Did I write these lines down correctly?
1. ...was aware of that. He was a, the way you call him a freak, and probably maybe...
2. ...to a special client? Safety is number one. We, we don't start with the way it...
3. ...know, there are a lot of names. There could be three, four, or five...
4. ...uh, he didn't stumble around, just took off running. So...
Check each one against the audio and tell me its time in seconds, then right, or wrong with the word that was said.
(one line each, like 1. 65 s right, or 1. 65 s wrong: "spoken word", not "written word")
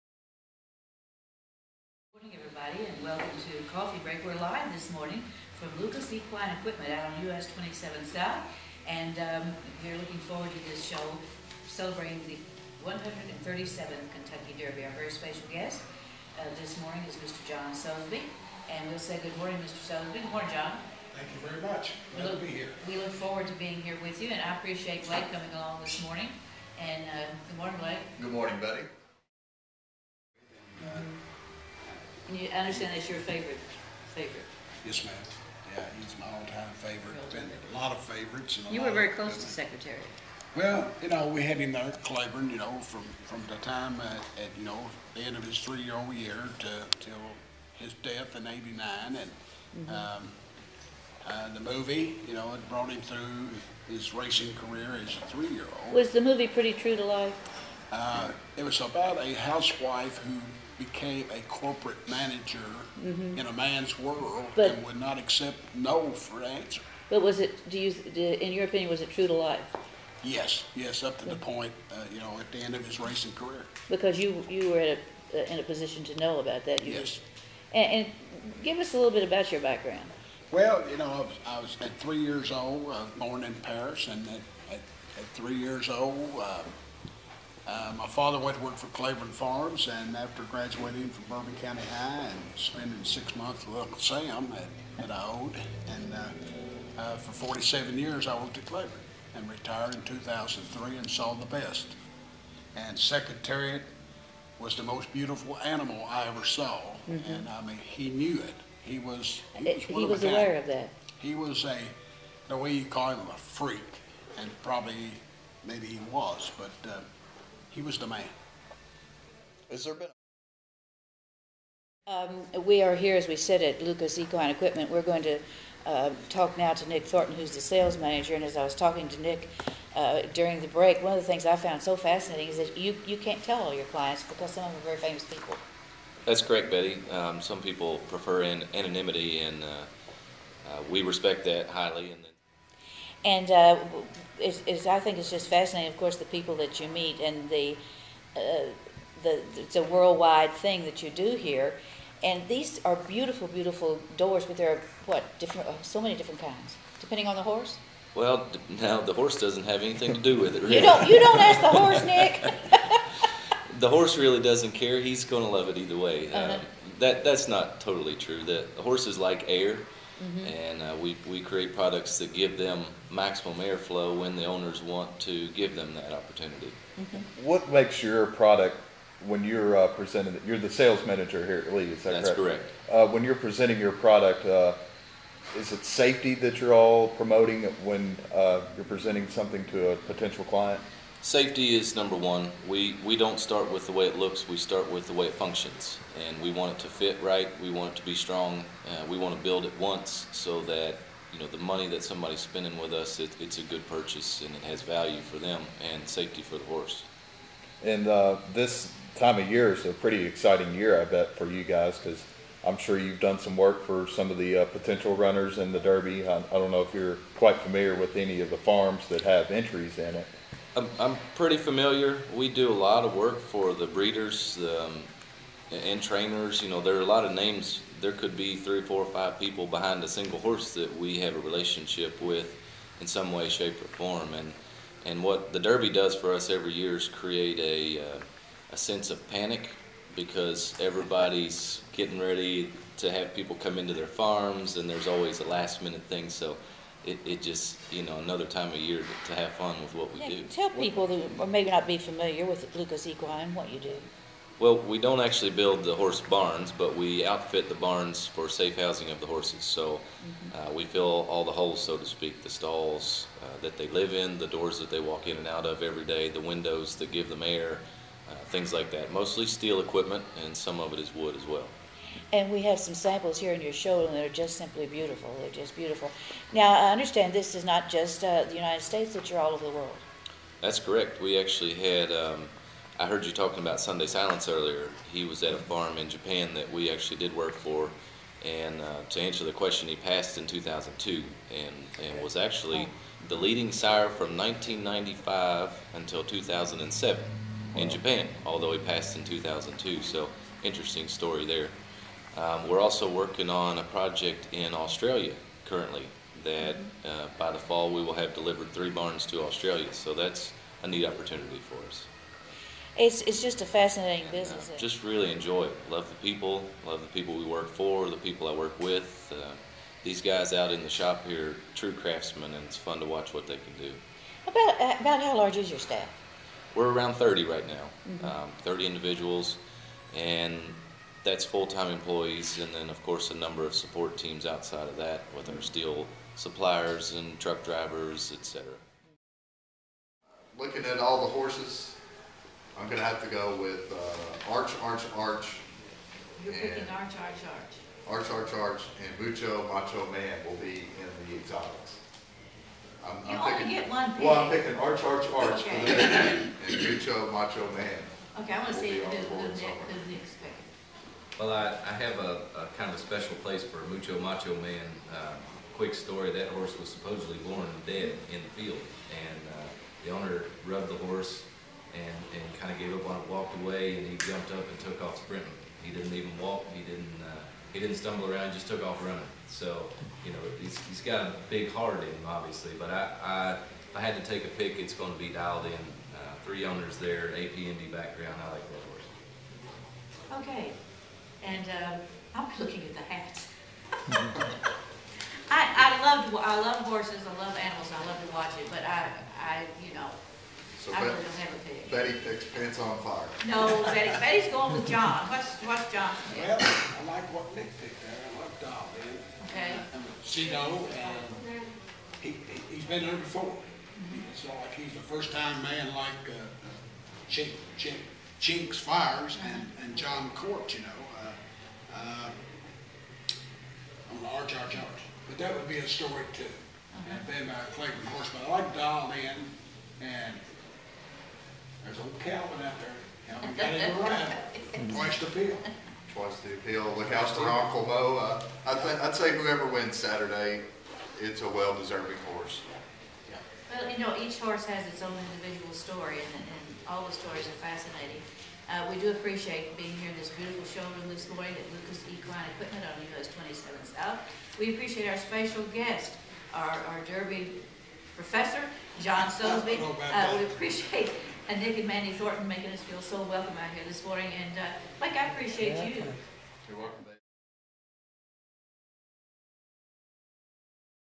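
1. 110 s right
2. 189 s wrong: "potential", not "special"
3. 226 s right
4. 377 s right.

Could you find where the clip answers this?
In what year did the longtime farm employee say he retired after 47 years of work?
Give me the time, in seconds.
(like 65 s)
100 s.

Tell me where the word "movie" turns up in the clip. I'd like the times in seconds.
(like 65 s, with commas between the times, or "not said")
51 s, 56 s.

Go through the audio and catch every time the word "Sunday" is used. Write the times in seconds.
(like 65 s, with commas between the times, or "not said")
283 s.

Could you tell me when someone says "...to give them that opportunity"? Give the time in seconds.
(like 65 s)
175 s.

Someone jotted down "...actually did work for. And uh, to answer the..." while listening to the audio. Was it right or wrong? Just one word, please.
right.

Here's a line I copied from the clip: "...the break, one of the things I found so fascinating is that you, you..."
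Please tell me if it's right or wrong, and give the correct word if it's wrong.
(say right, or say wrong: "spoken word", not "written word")
right.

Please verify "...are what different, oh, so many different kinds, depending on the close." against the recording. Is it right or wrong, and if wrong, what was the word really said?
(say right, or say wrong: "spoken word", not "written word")
wrong: "horse", not "close".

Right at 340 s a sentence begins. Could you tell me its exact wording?
Looking at all the horses, I'm going to have to go with uh, Arch, Arch, Arch.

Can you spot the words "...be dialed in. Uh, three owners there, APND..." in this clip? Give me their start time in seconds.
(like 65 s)
385 s.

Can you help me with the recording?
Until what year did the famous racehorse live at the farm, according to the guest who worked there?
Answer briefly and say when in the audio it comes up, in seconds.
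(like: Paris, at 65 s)
1989, at 48 s.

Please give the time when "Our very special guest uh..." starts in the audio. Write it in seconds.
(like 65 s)
14 s.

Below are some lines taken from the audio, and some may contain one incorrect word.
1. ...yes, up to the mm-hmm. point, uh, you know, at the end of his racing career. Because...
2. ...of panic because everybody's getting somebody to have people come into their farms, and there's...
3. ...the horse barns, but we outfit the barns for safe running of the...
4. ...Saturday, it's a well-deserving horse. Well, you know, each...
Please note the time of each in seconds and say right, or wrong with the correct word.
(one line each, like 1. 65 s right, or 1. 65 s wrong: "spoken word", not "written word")
1. 70 s right
2. 239 s wrong: "ready", not "somebody"
3. 255 s wrong: "housing", not "running"
4. 439 s right.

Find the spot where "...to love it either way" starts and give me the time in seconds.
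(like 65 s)
165 s.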